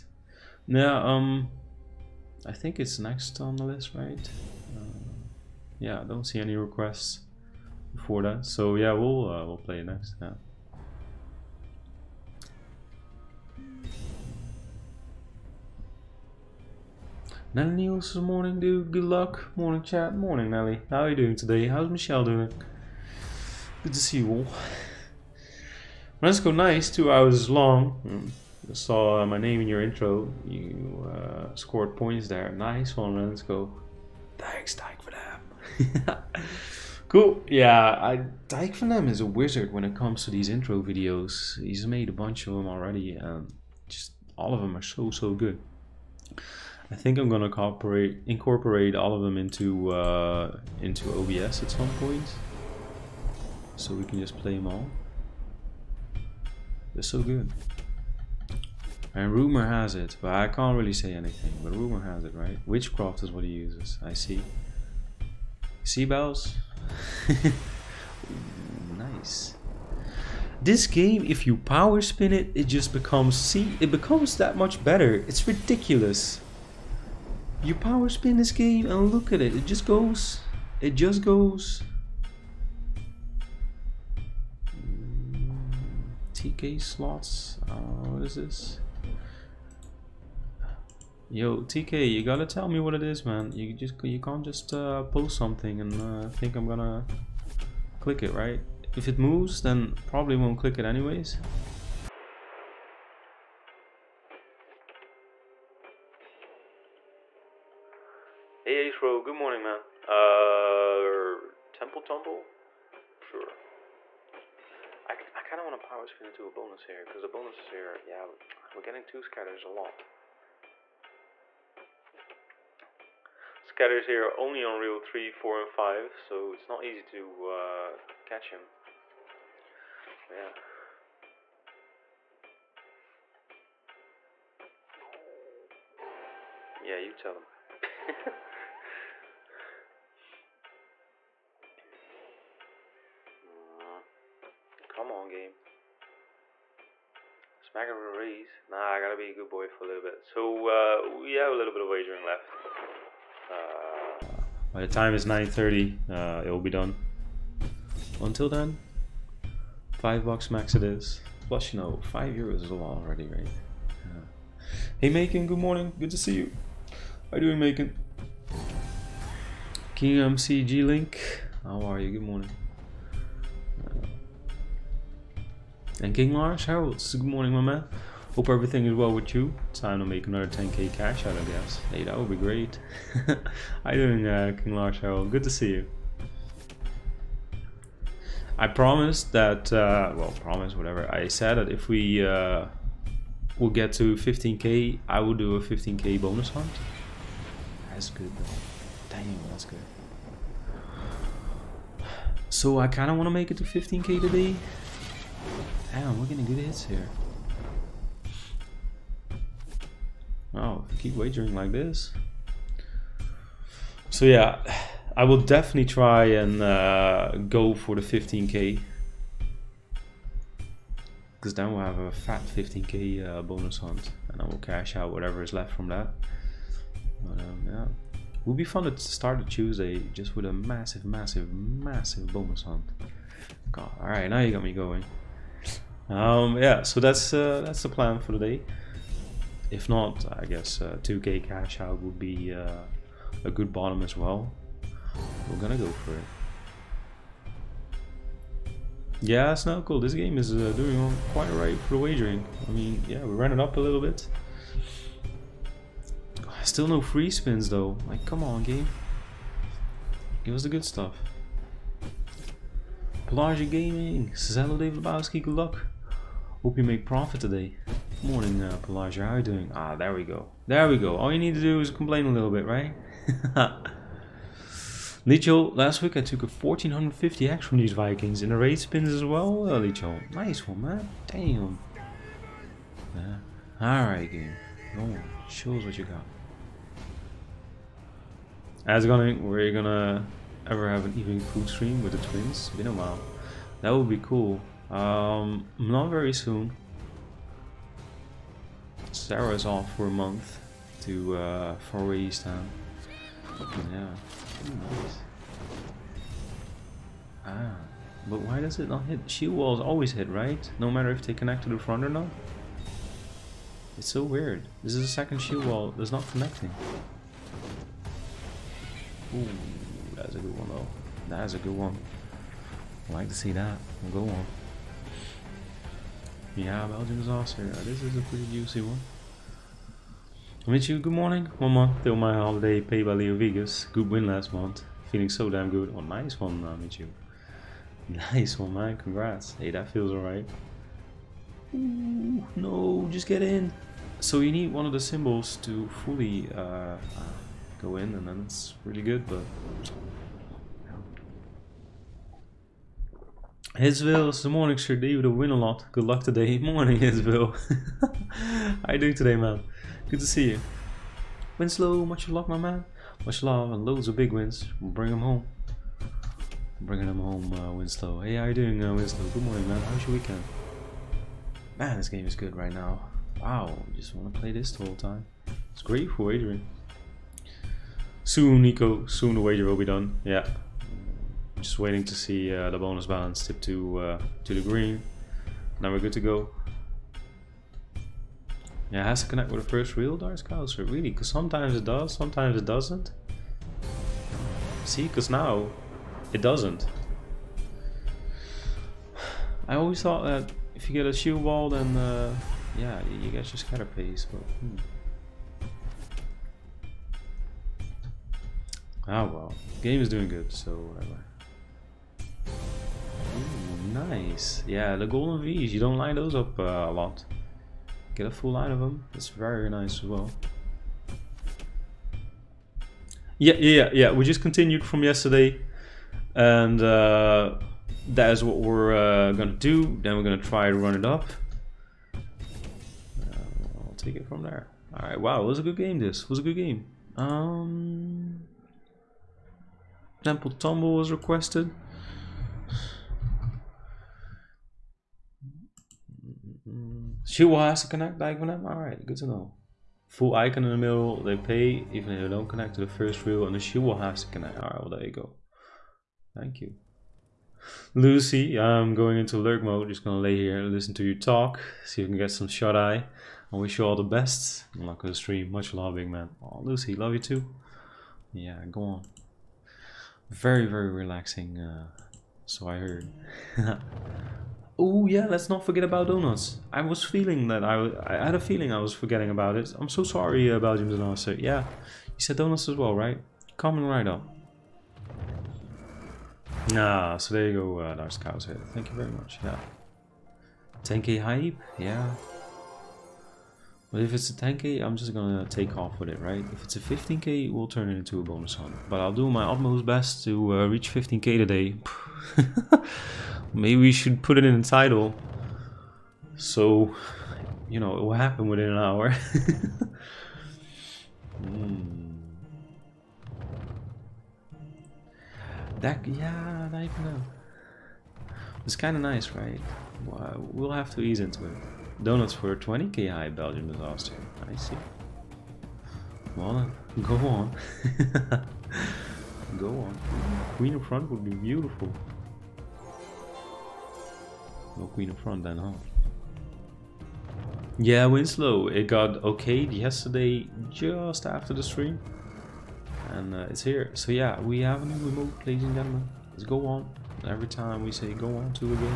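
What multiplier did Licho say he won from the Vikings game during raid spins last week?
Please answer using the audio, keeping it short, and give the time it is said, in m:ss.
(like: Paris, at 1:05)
1450x, at 4:36.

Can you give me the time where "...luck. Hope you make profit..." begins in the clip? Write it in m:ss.
4:25.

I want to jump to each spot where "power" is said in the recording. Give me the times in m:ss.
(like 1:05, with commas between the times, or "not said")
1:11, 1:17, 1:55.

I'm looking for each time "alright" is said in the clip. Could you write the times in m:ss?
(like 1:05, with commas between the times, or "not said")
3:54, 4:43, 5:40, 7:28, 7:34.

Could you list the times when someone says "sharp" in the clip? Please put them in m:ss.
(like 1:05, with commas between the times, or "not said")
not said.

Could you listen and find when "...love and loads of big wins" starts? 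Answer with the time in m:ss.
6:03.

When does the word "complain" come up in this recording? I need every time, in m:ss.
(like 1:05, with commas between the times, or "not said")
4:31.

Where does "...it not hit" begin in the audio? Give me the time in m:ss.
5:08.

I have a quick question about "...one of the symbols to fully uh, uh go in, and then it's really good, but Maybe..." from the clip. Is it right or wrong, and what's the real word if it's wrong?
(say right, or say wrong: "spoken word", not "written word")
wrong: "Isville", not "Maybe".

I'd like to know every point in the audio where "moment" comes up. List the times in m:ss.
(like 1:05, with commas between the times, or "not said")
not said.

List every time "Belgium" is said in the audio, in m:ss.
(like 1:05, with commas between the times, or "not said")
5:26, 8:00, 8:43.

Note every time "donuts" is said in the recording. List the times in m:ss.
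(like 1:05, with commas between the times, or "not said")
7:56, 8:02, 8:42.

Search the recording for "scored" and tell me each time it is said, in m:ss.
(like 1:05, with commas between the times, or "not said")
0:31.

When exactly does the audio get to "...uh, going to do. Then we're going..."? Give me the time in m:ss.
7:08.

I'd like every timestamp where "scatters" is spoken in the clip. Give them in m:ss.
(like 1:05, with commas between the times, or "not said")
1:59, 2:03, 6:43.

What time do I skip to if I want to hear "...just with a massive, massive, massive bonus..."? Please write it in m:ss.
3:50.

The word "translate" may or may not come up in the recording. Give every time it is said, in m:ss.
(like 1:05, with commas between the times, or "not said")
not said.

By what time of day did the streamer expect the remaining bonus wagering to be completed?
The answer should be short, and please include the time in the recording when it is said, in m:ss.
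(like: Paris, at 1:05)
9:30, at 2:35.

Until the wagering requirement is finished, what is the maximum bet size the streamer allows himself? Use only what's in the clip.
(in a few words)
5 bucks.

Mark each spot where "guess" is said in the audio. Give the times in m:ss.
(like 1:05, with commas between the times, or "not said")
3:01, 4:00.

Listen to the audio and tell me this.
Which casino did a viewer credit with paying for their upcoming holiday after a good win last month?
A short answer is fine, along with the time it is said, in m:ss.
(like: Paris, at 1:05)
Leo Vegas, at 5:33.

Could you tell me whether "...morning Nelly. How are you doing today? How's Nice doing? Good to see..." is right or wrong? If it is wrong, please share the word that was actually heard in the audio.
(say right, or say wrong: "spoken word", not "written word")
wrong: "Michelle", not "Nice".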